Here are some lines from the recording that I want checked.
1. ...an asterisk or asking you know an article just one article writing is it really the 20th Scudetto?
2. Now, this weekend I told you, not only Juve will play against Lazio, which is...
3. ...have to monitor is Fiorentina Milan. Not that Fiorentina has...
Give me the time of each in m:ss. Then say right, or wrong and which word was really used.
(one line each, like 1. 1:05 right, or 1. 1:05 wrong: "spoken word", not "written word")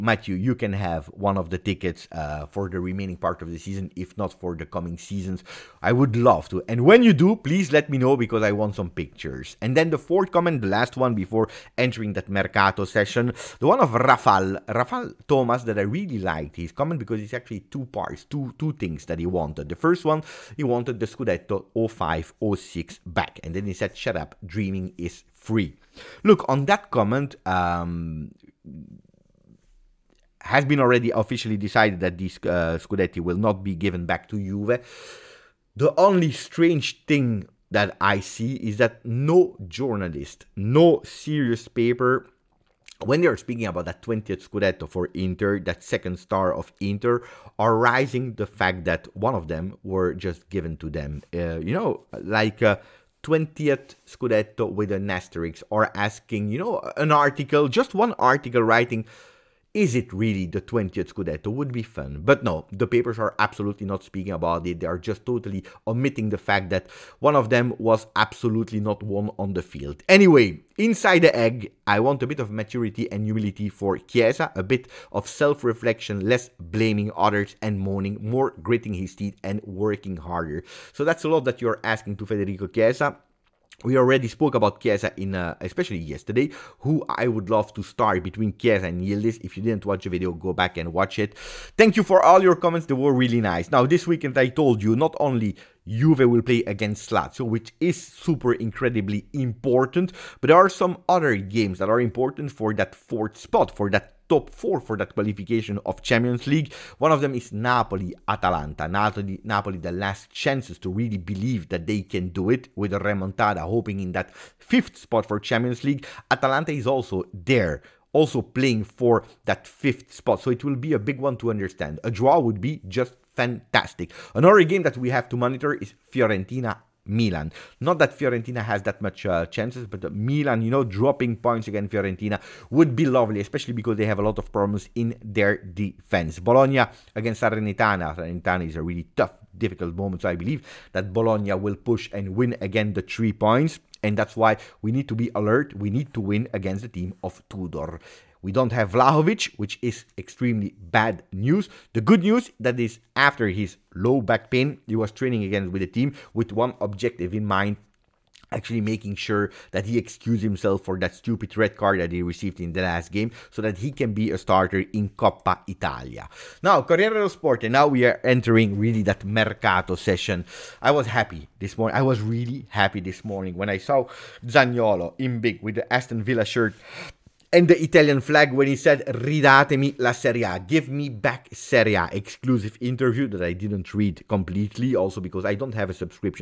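1. 0:54 right
2. 1:33 right
3. 2:05 right.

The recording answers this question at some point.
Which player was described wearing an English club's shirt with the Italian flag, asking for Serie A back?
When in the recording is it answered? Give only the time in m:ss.
2:54.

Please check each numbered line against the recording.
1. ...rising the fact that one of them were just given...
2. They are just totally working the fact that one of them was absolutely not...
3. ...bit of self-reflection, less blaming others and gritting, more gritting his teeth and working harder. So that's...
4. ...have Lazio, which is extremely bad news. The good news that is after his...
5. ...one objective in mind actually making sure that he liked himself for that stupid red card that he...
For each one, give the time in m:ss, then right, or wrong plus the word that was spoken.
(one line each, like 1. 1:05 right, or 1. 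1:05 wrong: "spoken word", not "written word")
1. 0:47 right
2. 1:04 wrong: "omitting", not "working"
3. 1:14 wrong: "moaning", not "gritting"
4. 2:28 wrong: "Vlahovic", not "Lazio"
5. 2:36 wrong: "excused", not "liked".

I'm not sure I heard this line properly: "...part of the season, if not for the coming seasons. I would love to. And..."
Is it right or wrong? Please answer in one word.
right.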